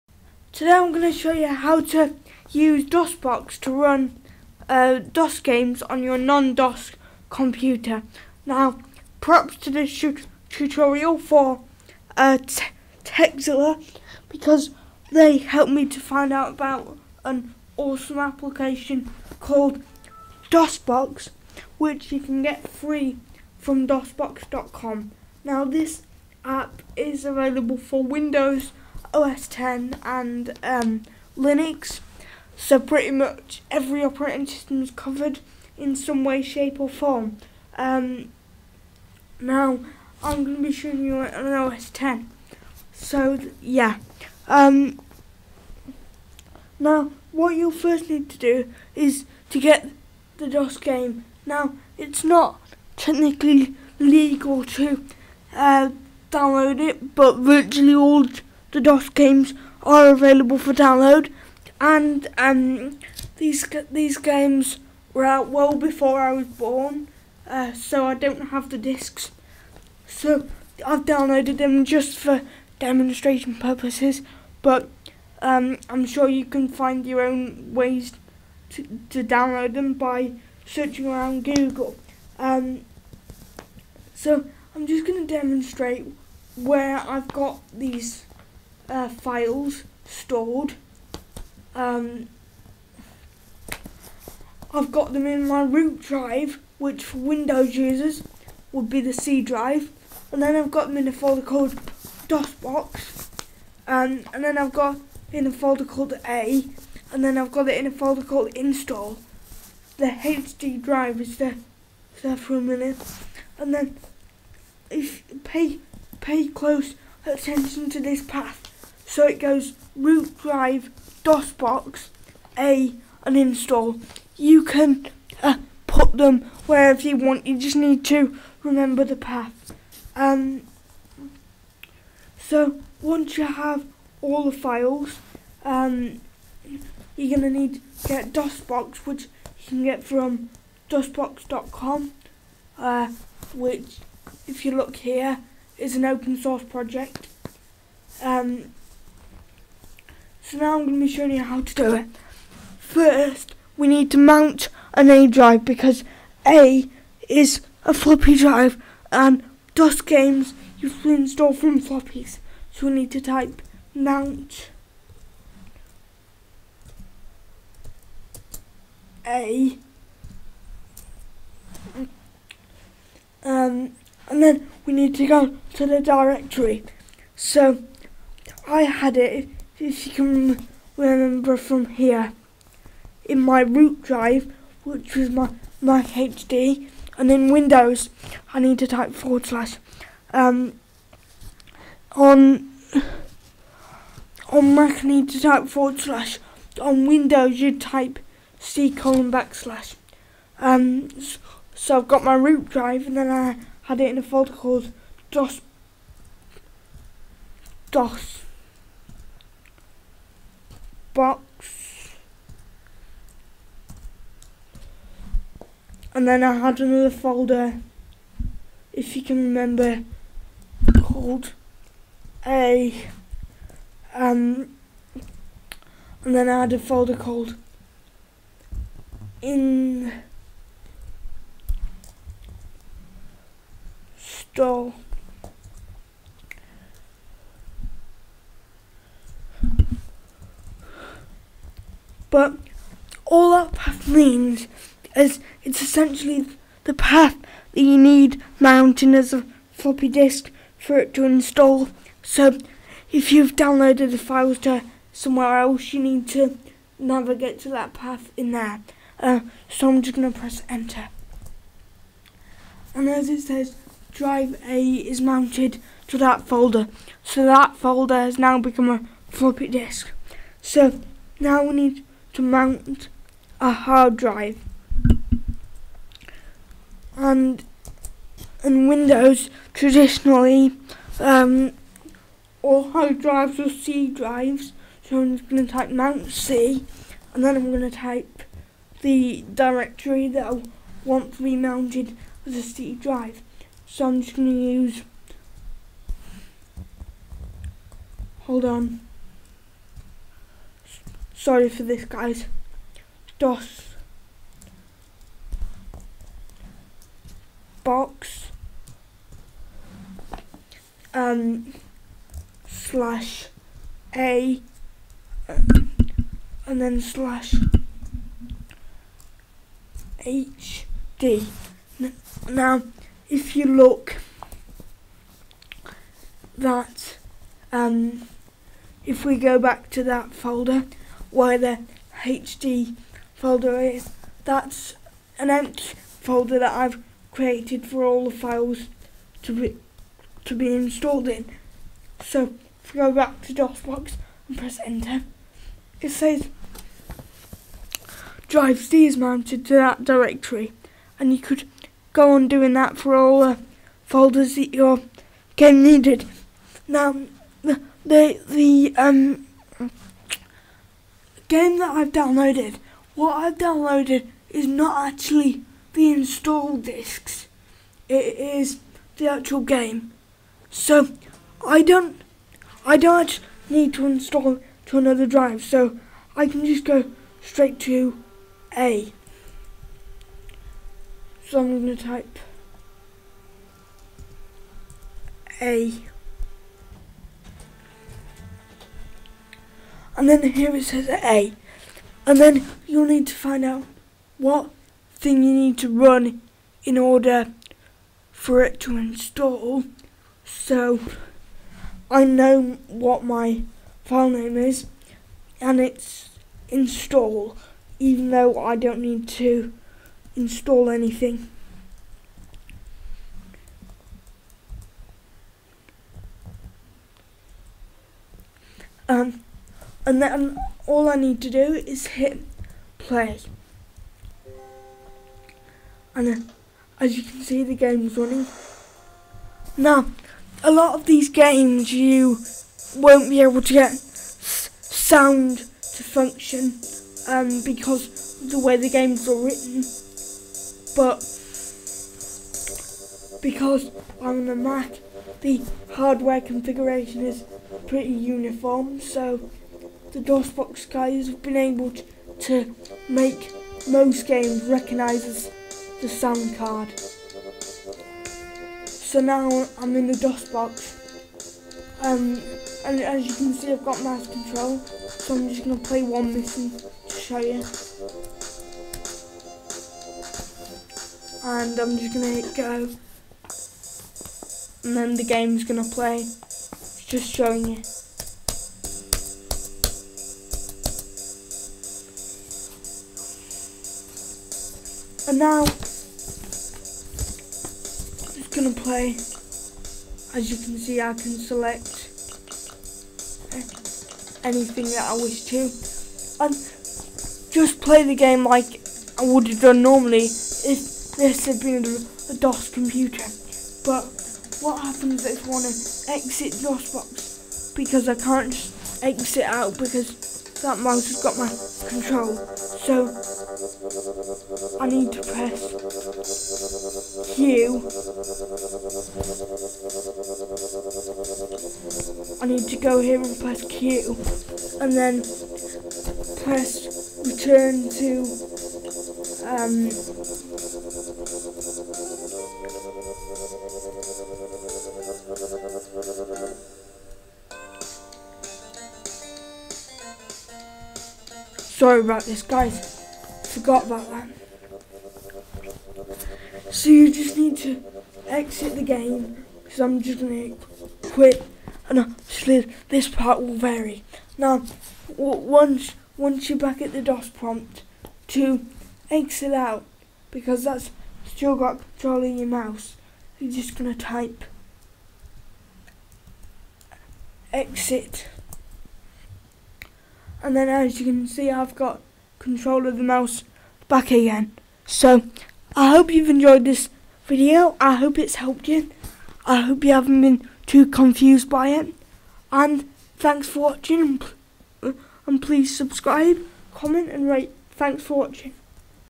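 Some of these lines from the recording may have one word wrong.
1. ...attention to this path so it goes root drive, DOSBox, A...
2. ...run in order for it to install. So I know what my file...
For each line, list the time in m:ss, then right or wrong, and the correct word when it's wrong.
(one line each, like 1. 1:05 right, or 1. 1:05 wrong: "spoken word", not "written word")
1. 1:57 right
2. 6:35 right.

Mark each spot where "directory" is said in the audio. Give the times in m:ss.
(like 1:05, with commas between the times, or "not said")
2:56, 4:49, 5:50.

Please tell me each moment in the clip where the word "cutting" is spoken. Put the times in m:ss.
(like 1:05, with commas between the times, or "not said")
not said.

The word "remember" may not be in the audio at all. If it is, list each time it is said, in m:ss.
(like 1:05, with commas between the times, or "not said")
2:08, 3:00, 3:39.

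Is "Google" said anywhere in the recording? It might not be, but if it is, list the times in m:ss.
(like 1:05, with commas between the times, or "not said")
1:21.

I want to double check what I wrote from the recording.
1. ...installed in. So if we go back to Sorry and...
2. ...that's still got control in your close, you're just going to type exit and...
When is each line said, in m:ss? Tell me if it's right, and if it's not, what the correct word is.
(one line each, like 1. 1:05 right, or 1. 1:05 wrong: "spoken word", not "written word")
1. 5:40 wrong: "DOSBox", not "Sorry"
2. 9:20 wrong: "mouse", not "close".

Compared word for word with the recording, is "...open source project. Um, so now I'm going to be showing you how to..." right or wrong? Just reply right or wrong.
right.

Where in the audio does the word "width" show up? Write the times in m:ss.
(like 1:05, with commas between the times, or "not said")
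not said.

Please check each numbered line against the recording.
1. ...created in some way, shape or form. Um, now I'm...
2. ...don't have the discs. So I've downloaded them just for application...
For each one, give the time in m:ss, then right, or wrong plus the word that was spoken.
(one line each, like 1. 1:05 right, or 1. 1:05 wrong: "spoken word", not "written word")
1. 0:34 wrong: "covered", not "created"
2. 1:08 wrong: "demonstration", not "application".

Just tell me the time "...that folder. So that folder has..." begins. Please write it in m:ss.
4:26.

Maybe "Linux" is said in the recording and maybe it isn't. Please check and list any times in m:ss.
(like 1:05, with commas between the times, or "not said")
0:31.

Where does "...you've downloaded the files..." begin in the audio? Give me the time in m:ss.
4:13.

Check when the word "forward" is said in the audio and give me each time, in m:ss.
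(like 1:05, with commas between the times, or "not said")
3:09, 3:15.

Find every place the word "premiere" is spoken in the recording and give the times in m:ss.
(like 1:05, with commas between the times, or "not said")
not said.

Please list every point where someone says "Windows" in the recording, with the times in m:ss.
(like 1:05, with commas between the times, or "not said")
0:28, 1:37, 3:07, 3:17, 4:38.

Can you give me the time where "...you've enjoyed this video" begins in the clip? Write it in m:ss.
9:36.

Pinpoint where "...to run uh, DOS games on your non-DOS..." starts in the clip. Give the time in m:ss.
0:03.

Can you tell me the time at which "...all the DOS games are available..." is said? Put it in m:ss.
0:57.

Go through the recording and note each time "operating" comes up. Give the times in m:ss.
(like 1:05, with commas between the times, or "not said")
0:34.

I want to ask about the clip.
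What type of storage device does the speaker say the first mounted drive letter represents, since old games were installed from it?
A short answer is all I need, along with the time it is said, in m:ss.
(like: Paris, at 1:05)
floppy drive, at 2:37.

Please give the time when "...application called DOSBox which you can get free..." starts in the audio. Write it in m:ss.
0:18.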